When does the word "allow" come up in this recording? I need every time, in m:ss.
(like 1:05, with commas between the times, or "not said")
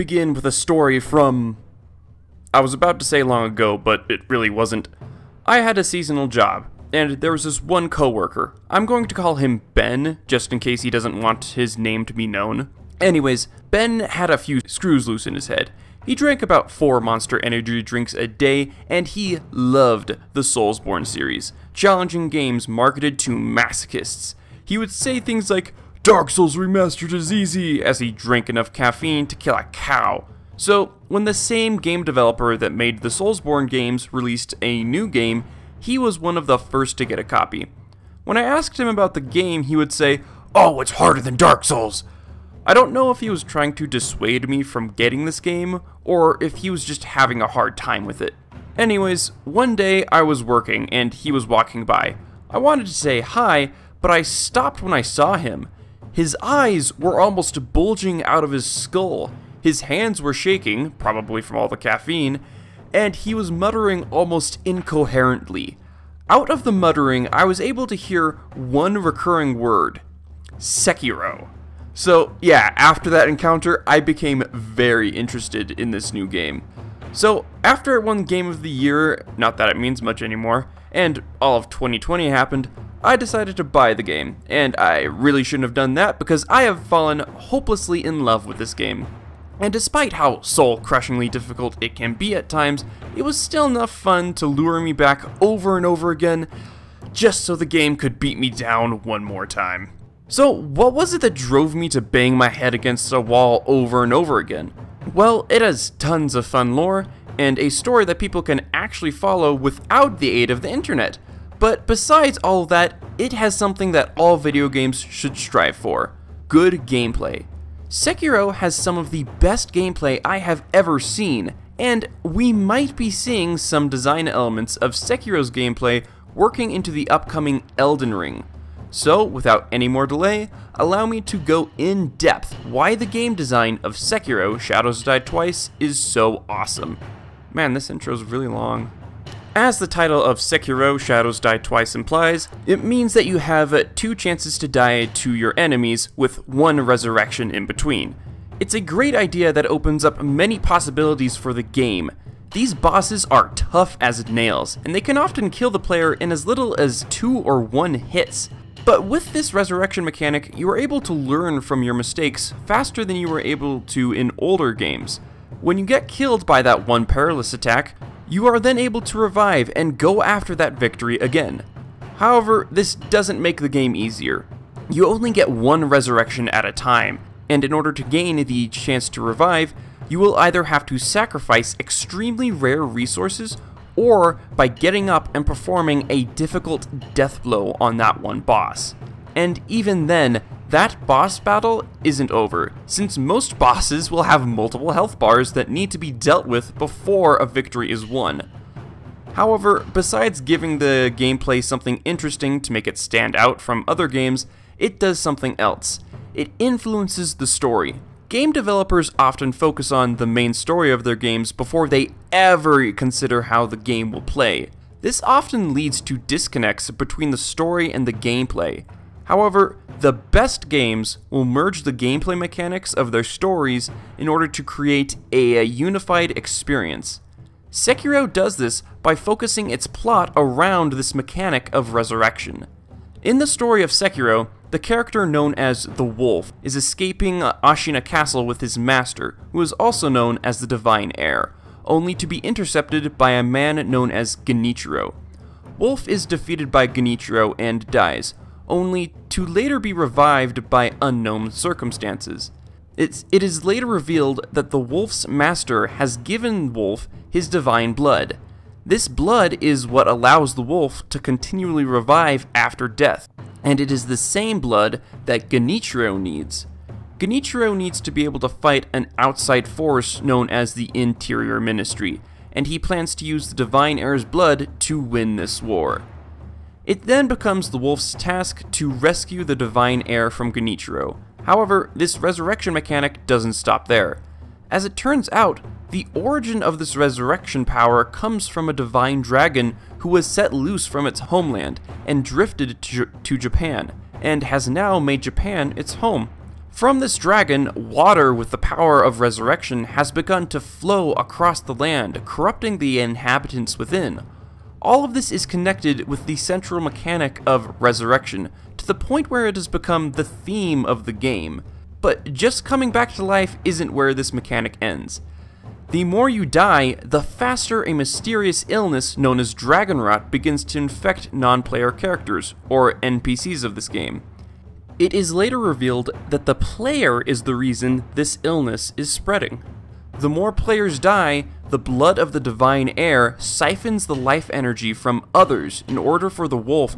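2:10, 4:20.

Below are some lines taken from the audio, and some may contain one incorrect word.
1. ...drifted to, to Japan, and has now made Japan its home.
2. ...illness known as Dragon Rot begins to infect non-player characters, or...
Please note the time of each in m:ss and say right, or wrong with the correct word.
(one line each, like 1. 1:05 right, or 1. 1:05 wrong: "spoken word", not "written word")
1. 4:52 right
2. 5:18 right.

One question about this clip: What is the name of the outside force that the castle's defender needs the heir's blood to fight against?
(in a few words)
Interior Ministry.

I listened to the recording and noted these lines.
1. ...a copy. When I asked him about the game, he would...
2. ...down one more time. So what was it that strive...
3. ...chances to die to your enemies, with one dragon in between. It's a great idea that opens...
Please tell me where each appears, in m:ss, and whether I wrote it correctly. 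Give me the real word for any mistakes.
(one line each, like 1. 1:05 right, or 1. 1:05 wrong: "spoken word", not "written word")
1. 0:37 right
2. 1:38 wrong: "drove", not "strive"
3. 2:24 wrong: "resurrection", not "dragon".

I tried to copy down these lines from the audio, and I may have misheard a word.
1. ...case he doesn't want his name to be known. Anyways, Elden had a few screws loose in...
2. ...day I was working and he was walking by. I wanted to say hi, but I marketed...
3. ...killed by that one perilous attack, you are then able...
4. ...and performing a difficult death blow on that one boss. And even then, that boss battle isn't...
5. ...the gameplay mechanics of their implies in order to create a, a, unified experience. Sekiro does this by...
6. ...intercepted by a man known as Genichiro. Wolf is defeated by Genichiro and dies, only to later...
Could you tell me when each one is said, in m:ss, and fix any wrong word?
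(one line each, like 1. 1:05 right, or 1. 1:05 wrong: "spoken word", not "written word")
1. 0:10 wrong: "Ben", not "Elden"
2. 0:49 wrong: "stopped", not "marketed"
3. 2:46 right
4. 3:05 right
5. 3:41 wrong: "stories", not "implies"
6. 4:02 right.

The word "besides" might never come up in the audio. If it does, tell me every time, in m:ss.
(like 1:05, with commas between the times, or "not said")
1:51, 3:19.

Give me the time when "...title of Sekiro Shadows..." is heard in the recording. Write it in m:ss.
2:19.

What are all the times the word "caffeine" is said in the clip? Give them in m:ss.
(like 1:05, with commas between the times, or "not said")
0:28, 1:01.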